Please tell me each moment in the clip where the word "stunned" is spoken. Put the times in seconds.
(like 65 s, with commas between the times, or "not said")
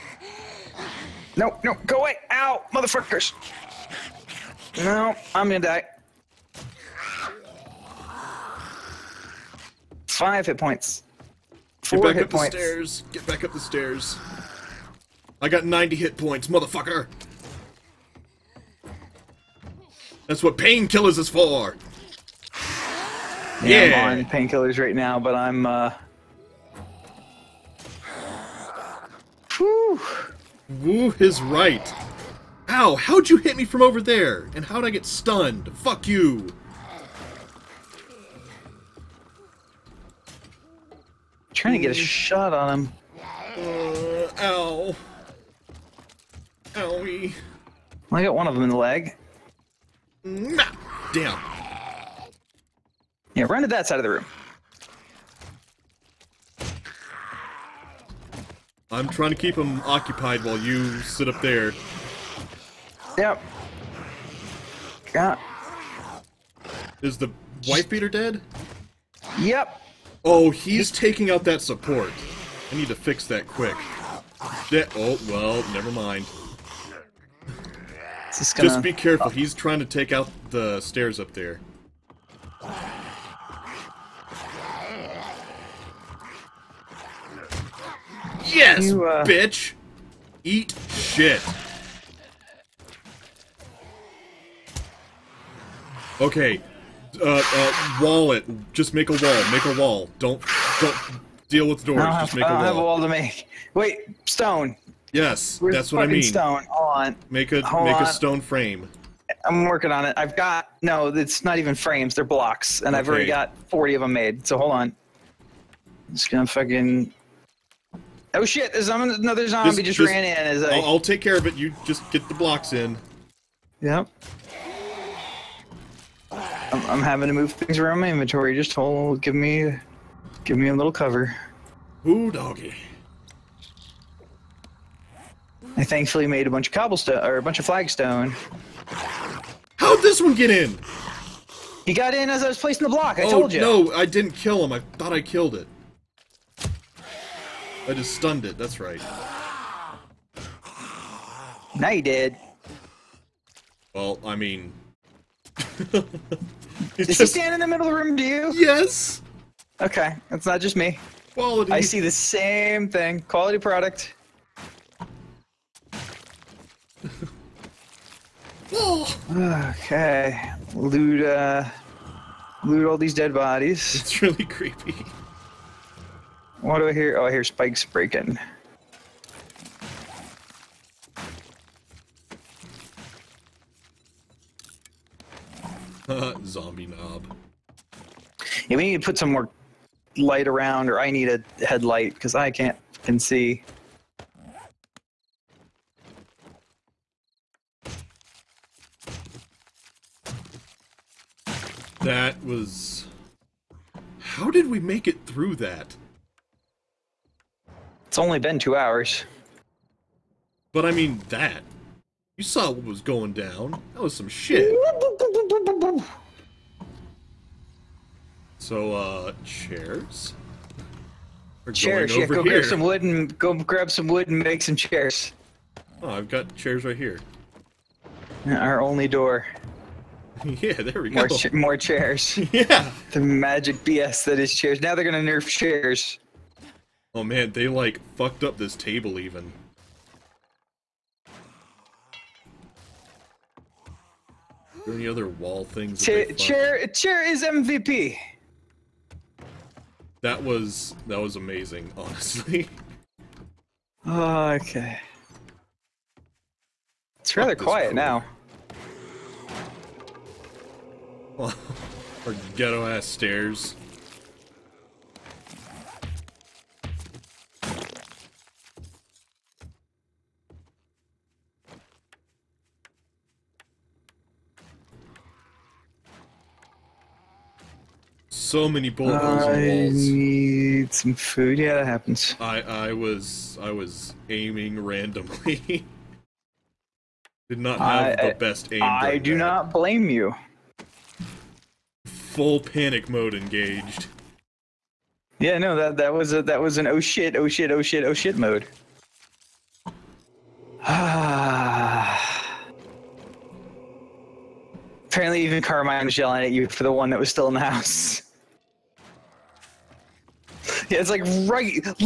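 35 s, 148 s.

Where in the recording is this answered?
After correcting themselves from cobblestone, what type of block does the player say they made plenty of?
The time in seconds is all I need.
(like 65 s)
137 s.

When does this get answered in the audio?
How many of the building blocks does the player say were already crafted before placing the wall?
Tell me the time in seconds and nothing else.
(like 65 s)
113 s.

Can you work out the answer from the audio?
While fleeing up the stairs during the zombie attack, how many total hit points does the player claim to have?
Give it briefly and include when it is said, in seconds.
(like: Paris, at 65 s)
90, at 15 s.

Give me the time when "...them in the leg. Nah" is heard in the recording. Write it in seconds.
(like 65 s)
48 s.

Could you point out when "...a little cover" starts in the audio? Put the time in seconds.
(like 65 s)
130 s.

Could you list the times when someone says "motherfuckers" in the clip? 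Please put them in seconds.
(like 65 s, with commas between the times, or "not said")
2 s, 16 s.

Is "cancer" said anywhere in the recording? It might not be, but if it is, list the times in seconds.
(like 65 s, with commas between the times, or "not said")
not said.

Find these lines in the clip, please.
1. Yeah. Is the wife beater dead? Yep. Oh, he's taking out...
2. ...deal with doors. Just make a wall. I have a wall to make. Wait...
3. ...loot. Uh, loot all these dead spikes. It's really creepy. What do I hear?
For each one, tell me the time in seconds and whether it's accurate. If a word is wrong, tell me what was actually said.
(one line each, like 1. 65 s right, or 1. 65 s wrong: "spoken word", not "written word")
1. 65 s right
2. 101 s right
3. 170 s wrong: "bodies", not "spikes".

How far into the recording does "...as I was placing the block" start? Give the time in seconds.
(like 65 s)
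142 s.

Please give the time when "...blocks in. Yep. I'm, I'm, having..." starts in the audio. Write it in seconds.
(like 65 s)
122 s.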